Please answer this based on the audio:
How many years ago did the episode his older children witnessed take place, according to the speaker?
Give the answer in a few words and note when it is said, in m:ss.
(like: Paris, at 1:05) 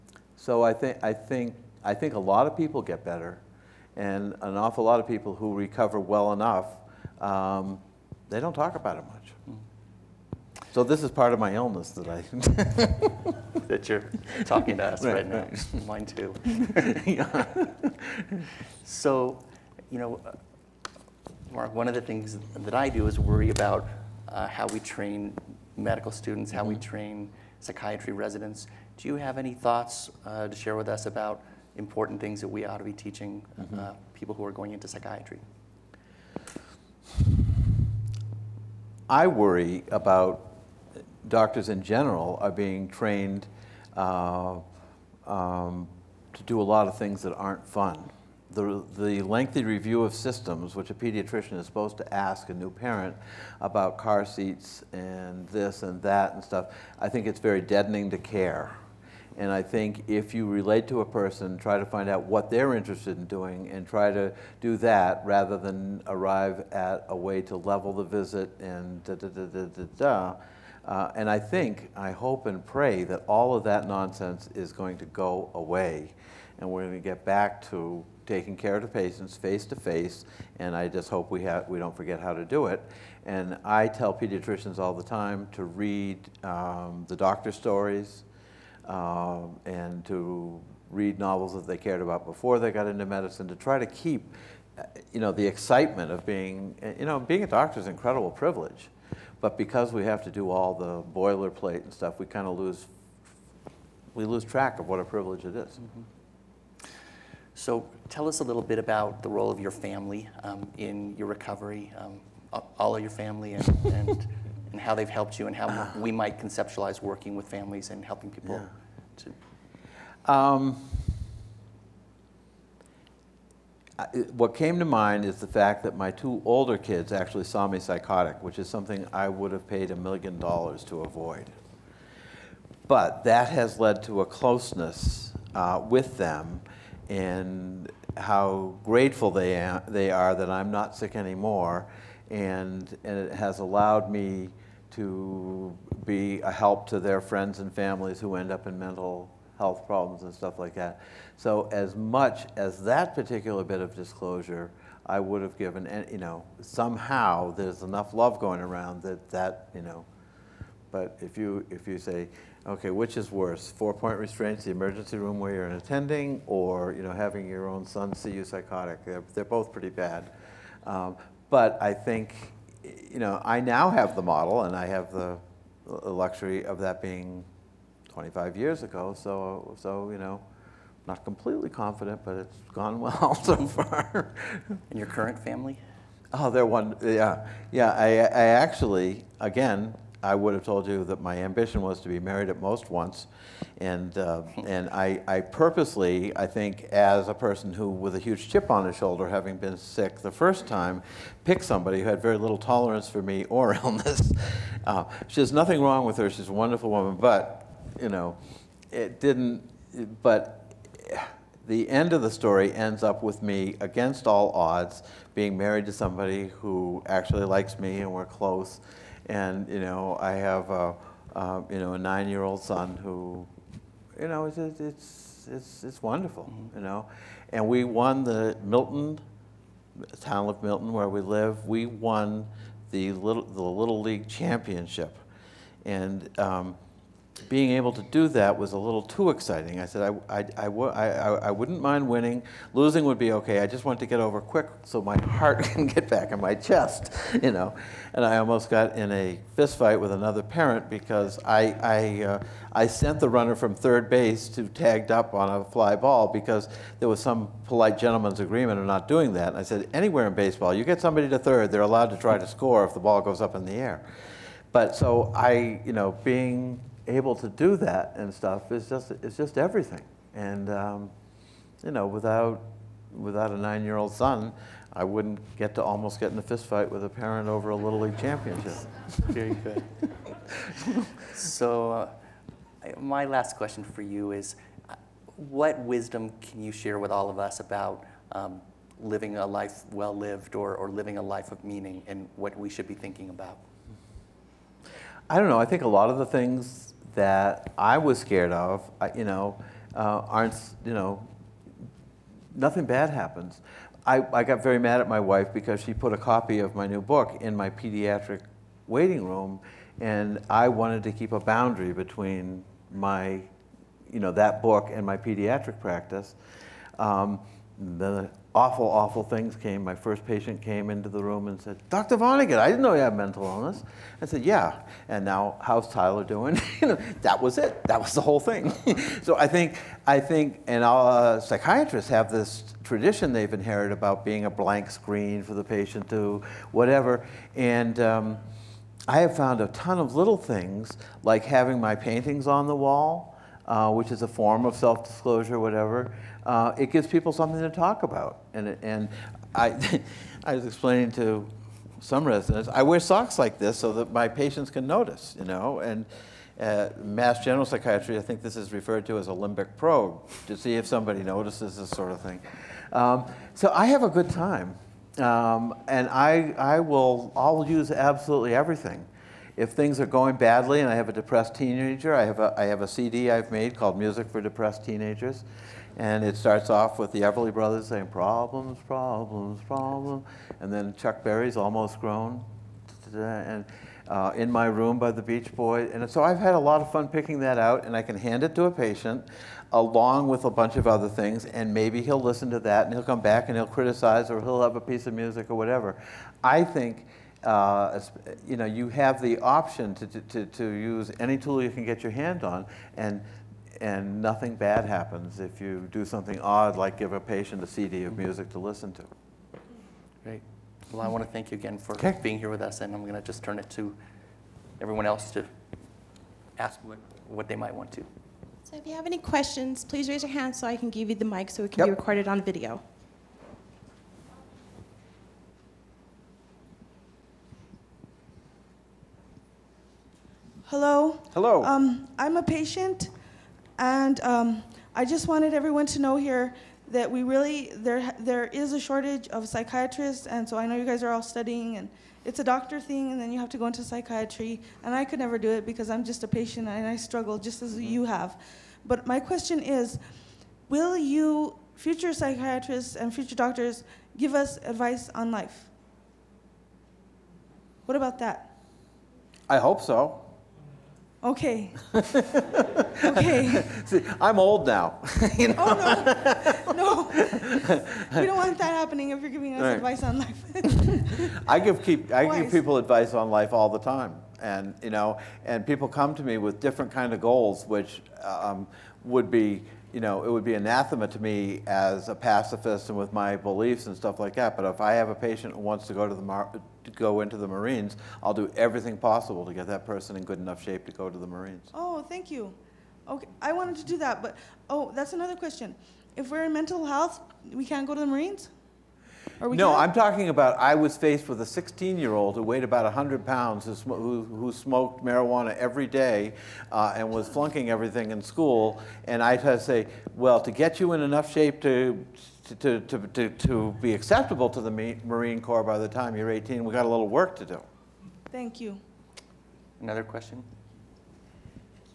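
25, at 2:58.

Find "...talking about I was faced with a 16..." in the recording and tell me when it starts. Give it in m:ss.
8:19.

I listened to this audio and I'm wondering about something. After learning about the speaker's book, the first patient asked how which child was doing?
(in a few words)
Tyler.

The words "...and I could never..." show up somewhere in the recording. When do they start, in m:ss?
7:24.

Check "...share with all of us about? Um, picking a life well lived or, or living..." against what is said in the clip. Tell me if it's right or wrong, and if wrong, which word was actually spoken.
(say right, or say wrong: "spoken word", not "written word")
wrong: "living", not "picking".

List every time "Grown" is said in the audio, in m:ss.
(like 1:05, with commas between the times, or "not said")
6:22.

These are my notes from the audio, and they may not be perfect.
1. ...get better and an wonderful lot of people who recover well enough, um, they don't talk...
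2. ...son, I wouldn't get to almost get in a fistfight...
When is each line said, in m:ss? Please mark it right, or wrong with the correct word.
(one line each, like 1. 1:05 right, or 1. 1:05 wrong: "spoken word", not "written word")
1. 0:02 wrong: "awful", not "wonderful"
2. 4:34 right.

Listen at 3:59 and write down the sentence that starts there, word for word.
I said, I, I, I, wouldn't mind winning.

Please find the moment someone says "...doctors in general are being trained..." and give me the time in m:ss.
0:41.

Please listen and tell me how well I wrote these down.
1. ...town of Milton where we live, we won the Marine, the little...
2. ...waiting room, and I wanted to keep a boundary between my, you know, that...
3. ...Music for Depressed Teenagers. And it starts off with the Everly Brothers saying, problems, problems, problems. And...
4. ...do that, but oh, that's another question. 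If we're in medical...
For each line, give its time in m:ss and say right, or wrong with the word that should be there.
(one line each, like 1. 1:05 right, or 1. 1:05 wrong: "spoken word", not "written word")
1. 3:50 wrong: "Little", not "Marine"
2. 5:08 right
3. 6:13 right
4. 8:13 wrong: "mental", not "medical".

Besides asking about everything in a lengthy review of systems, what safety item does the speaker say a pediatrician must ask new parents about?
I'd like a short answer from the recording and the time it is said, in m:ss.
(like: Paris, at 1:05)
car seats, at 0:53.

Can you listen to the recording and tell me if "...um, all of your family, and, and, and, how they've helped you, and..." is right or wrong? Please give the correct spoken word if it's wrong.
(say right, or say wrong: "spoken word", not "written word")
right.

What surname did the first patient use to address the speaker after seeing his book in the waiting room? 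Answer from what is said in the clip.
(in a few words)
Vonnegut.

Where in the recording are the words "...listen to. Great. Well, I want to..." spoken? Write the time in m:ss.
6:48.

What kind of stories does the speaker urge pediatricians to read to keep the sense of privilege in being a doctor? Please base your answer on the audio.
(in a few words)
doctor stories.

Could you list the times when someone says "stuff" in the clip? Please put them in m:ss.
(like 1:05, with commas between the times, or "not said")
0:56, 1:41, 2:30, 4:28, 8:03.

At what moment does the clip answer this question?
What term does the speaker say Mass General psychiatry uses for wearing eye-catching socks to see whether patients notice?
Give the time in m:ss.
5:59.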